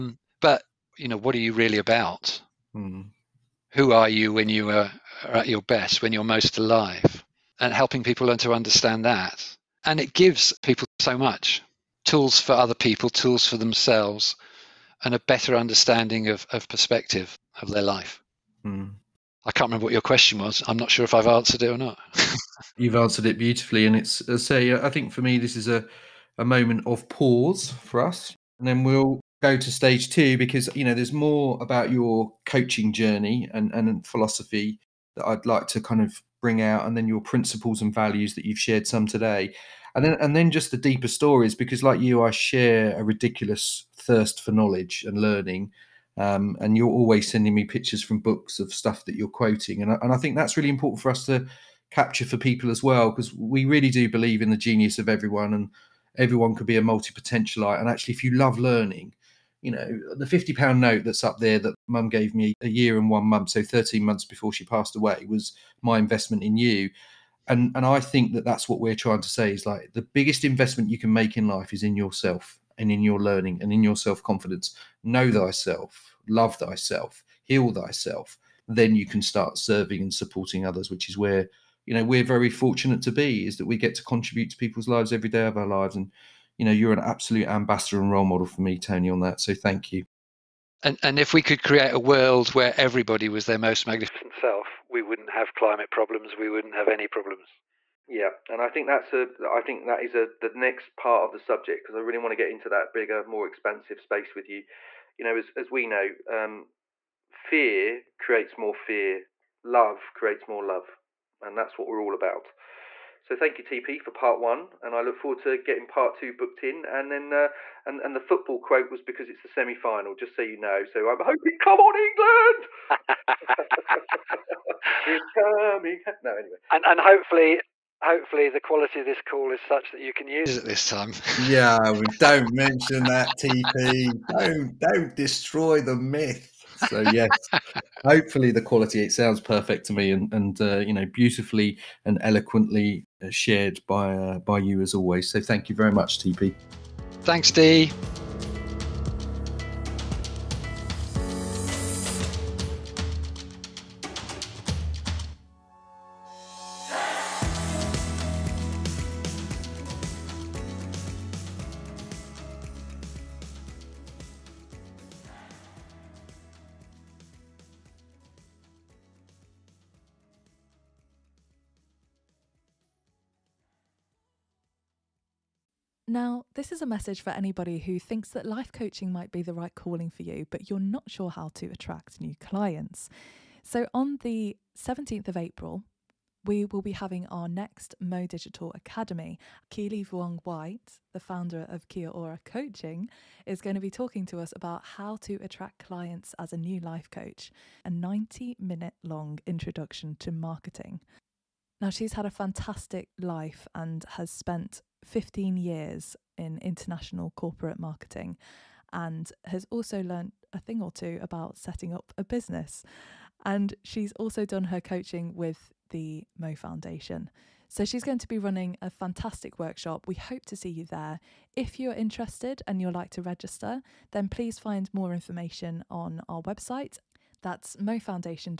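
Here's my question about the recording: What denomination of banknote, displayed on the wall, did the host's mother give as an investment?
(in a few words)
£50.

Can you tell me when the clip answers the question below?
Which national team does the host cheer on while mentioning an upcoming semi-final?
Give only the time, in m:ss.
2:02.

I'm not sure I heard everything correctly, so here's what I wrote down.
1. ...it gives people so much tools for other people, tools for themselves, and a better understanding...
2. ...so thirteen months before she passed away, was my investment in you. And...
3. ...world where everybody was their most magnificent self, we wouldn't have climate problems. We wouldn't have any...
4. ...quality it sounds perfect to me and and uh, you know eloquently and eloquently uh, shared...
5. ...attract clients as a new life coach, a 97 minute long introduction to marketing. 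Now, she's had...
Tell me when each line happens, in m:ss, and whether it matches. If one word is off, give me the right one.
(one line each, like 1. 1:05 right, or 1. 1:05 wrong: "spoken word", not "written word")
1. 0:09 right
2. 1:03 right
3. 1:31 right
4. 2:18 wrong: "beautifully", not "eloquently"
5. 3:15 wrong: "90", not "97".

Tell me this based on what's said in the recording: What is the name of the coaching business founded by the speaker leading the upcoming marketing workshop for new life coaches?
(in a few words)
Kia Ora Coaching.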